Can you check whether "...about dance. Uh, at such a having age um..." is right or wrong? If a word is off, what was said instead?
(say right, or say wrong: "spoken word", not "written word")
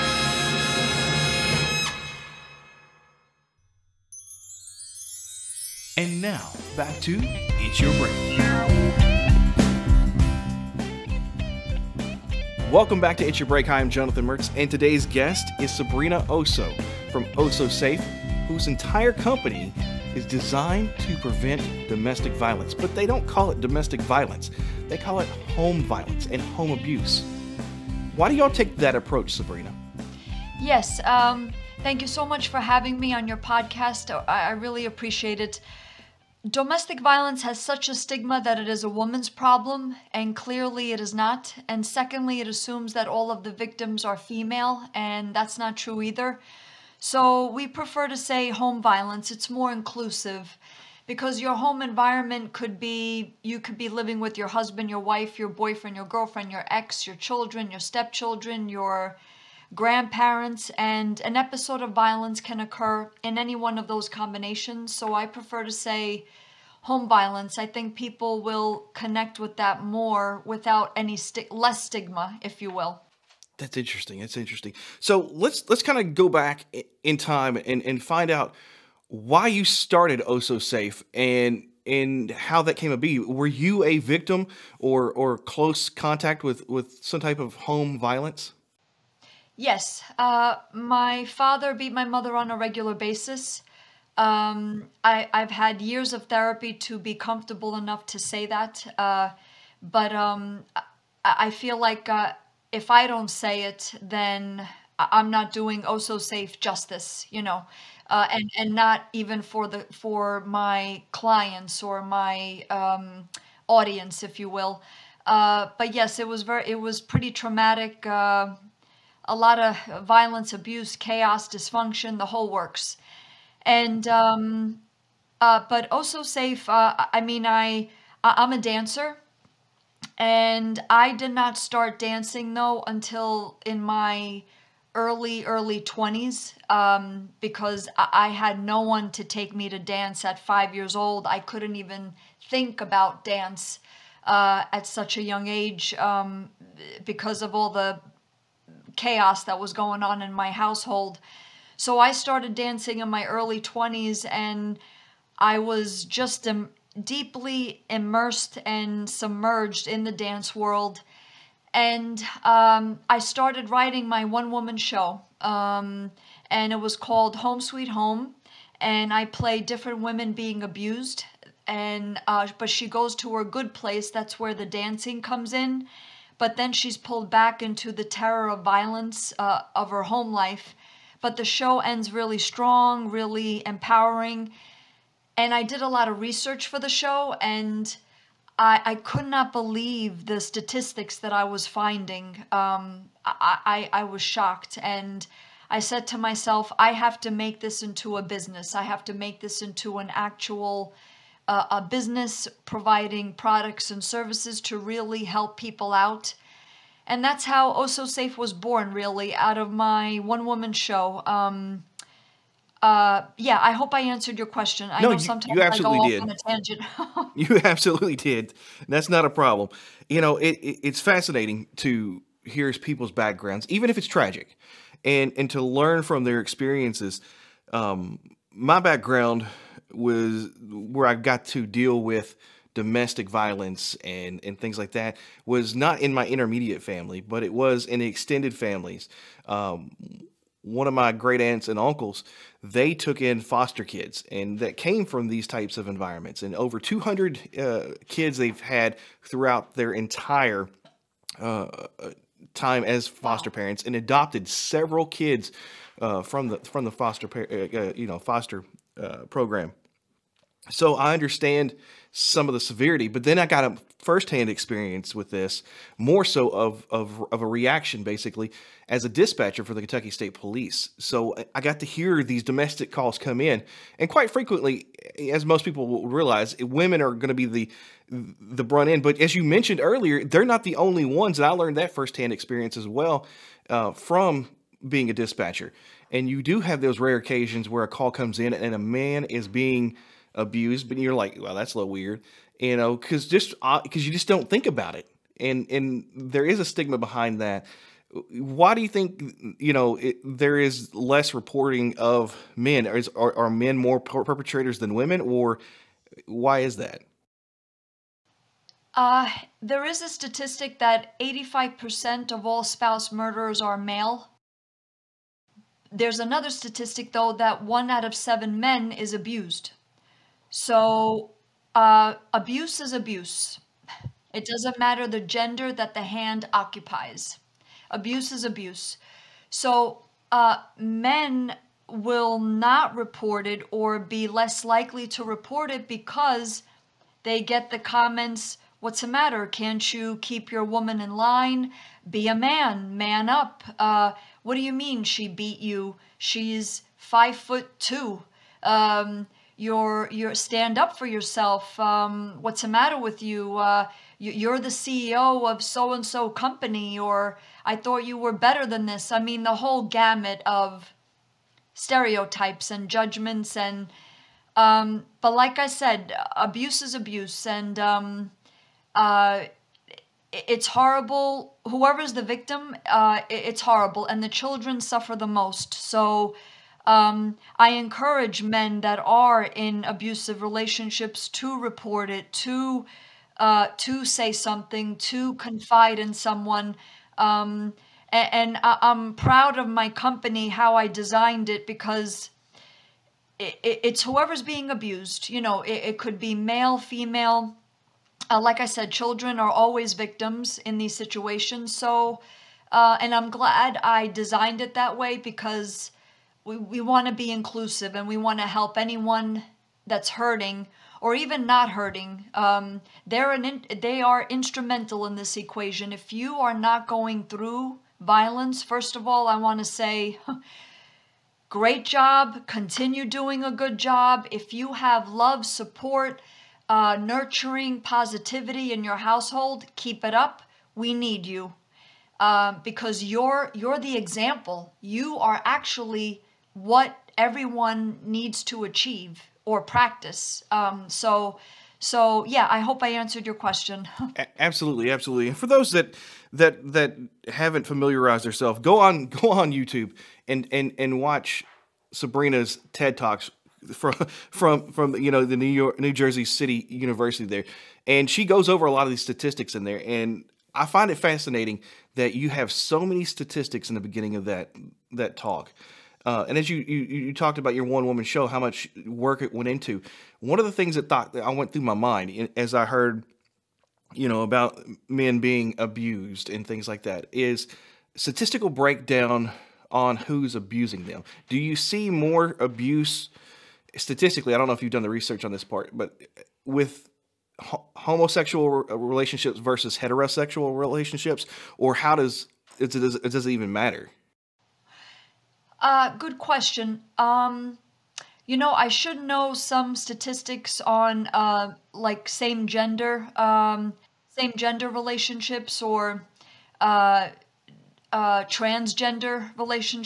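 wrong: "young", not "having".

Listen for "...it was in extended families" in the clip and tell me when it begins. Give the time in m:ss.
3:57.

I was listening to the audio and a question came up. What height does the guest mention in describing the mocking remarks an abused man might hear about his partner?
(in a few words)
five foot two.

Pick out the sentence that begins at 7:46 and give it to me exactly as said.
Uh, and as you, you, you talked about your one woman show, how much work it went into.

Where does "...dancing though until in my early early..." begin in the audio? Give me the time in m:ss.
2:11.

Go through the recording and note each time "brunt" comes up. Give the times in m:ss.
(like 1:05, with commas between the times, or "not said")
4:38.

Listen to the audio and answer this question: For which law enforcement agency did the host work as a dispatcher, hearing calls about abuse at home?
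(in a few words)
Kentucky State Police.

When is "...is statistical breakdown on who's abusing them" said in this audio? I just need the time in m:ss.
7:57.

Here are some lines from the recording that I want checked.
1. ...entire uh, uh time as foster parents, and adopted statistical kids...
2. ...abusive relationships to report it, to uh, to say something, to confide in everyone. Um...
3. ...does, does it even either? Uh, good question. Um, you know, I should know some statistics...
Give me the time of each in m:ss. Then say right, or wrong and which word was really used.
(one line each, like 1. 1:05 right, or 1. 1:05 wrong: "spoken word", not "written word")
1. 4:09 wrong: "several", not "statistical"
2. 6:19 wrong: "someone", not "everyone"
3. 8:12 wrong: "matter", not "either".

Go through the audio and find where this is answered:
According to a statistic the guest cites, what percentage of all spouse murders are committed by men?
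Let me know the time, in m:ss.
5:11.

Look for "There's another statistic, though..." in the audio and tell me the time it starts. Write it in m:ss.
5:15.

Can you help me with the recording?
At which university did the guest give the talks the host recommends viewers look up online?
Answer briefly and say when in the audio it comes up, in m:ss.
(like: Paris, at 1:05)
New Jersey City University, at 7:35.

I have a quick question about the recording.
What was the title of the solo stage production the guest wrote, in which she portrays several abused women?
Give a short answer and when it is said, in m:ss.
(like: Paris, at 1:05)
Home Sweet Home, at 2:47.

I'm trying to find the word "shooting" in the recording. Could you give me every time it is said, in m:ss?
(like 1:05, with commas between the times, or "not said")
not said.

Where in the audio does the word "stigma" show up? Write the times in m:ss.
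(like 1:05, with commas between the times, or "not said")
0:37, 1:11, 4:56.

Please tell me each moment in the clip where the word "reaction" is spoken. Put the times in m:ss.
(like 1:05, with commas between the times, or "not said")
4:27.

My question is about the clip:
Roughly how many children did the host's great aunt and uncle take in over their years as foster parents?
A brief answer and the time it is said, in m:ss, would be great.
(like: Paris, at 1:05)
200, at 4:06.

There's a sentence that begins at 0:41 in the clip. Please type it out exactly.
And secondly, it assumes that all of the victims are female, and that's not true either.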